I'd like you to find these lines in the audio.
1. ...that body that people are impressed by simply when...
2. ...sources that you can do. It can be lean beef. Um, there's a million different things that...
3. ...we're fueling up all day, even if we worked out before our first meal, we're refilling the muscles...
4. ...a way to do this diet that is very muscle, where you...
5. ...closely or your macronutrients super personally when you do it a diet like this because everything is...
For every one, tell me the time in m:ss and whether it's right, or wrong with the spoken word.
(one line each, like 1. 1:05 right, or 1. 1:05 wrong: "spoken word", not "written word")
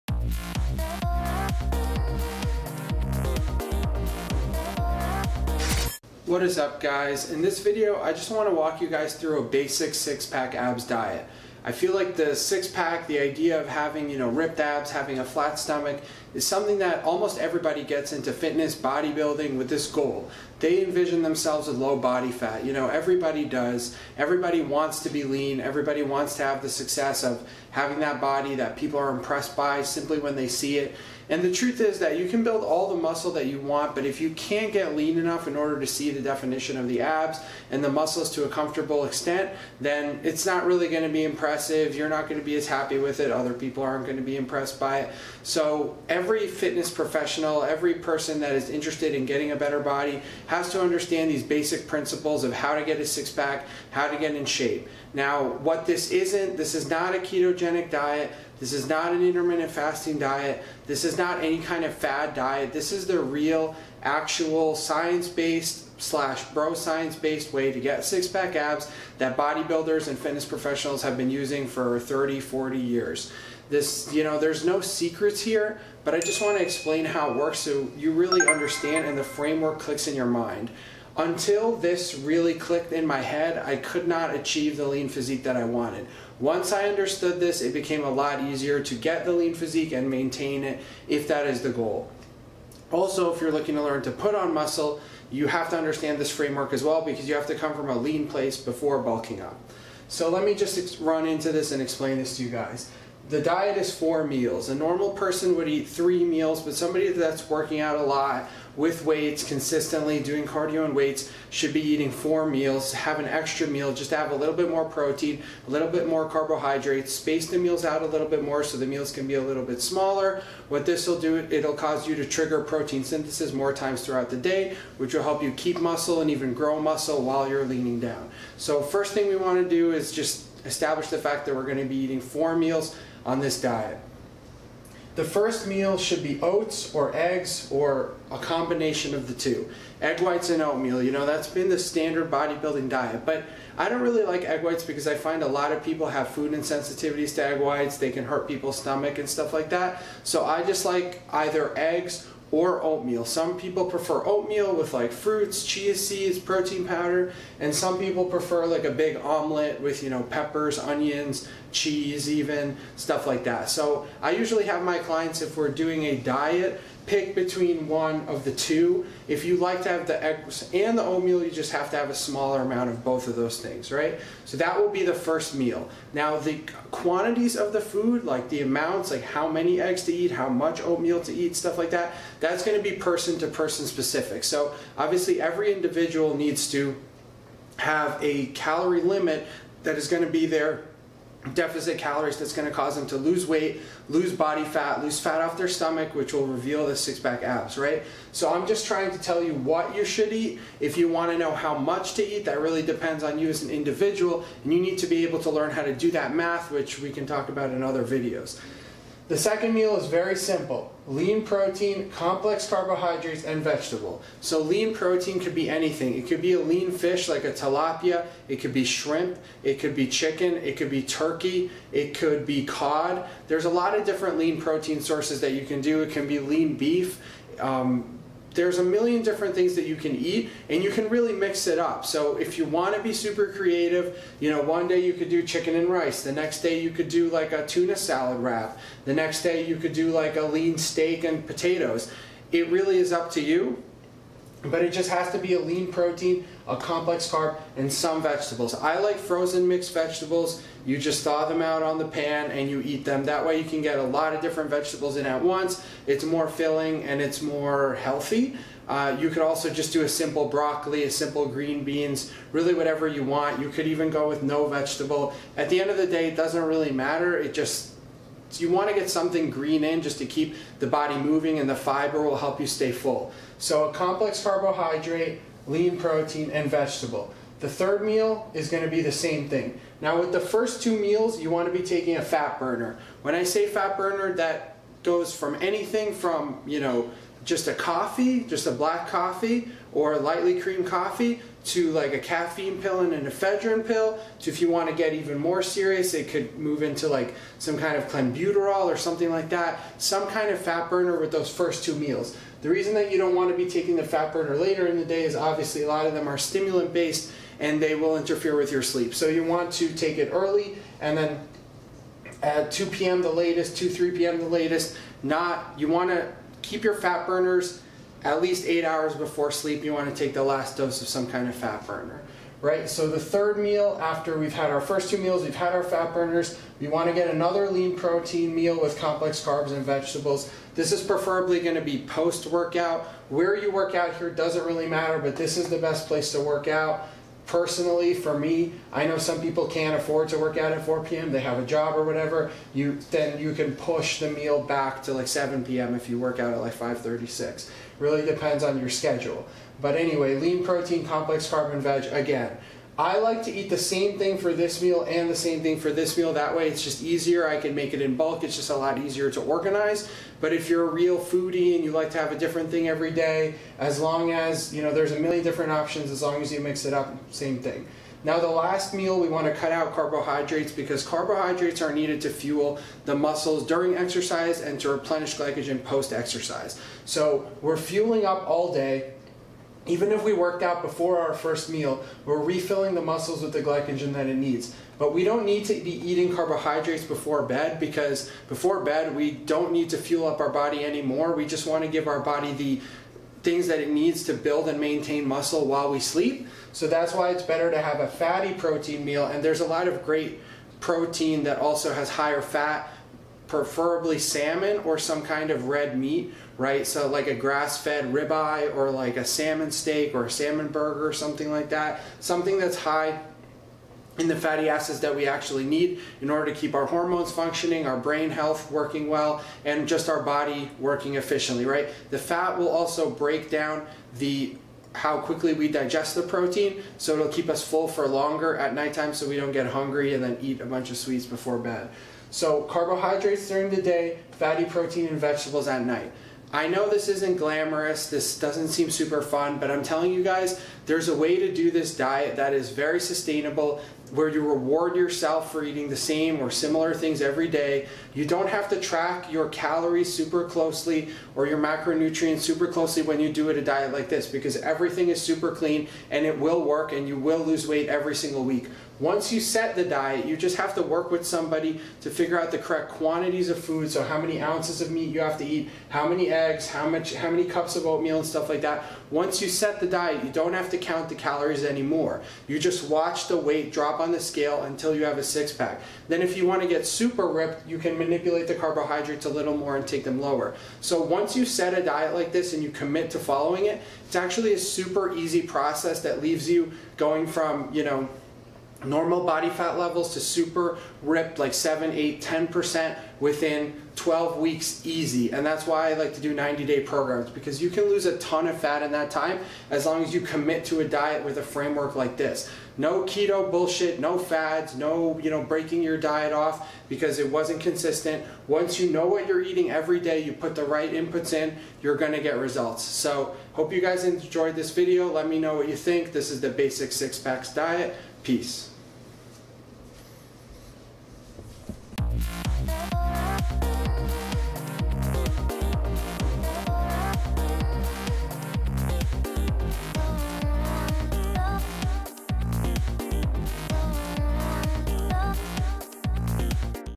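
1. 0:27 right
2. 3:45 right
3. 6:17 right
4. 7:21 wrong: "sustainable", not "muscle"
5. 7:30 wrong: "closely", not "personally".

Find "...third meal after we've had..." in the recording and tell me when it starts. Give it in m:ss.
5:23.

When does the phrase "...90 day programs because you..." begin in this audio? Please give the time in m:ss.
8:16.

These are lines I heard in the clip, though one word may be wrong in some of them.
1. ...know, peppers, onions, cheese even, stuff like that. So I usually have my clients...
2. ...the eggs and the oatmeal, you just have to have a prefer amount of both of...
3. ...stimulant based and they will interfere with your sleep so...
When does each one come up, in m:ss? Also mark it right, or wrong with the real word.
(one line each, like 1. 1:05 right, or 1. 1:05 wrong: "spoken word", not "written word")
1. 2:40 right
2. 2:50 wrong: "smaller", not "prefer"
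3. 5:06 right.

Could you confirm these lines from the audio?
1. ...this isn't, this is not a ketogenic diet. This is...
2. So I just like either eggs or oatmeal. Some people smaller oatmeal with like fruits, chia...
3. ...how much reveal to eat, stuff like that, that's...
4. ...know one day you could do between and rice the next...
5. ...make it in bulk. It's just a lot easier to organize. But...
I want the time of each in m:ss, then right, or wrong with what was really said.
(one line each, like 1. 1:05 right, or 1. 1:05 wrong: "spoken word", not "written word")
1. 0:55 right
2. 2:30 wrong: "prefer", not "smaller"
3. 3:00 wrong: "oatmeal", not "reveal"
4. 3:54 wrong: "chicken", not "between"
5. 5:57 right.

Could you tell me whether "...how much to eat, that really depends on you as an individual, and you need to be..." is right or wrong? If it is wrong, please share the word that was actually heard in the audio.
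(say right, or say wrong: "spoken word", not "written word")
right.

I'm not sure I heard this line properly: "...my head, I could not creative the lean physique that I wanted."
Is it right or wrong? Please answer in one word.
wrong.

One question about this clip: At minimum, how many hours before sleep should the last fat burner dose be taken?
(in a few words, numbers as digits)
8.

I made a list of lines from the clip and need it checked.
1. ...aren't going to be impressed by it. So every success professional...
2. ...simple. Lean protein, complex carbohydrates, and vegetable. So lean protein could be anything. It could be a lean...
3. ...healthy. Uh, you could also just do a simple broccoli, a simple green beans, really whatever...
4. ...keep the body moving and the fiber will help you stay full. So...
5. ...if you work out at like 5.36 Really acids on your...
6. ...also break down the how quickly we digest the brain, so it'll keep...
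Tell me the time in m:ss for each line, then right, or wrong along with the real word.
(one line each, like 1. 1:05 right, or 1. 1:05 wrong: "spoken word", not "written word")
1. 0:43 wrong: "fitness", not "success"
2. 3:30 right
3. 4:17 right
4. 4:30 right
5. 5:45 wrong: "depends", not "acids"
6. 7:02 wrong: "protein", not "brain".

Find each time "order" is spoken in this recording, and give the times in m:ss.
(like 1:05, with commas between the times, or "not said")
0:35, 6:56.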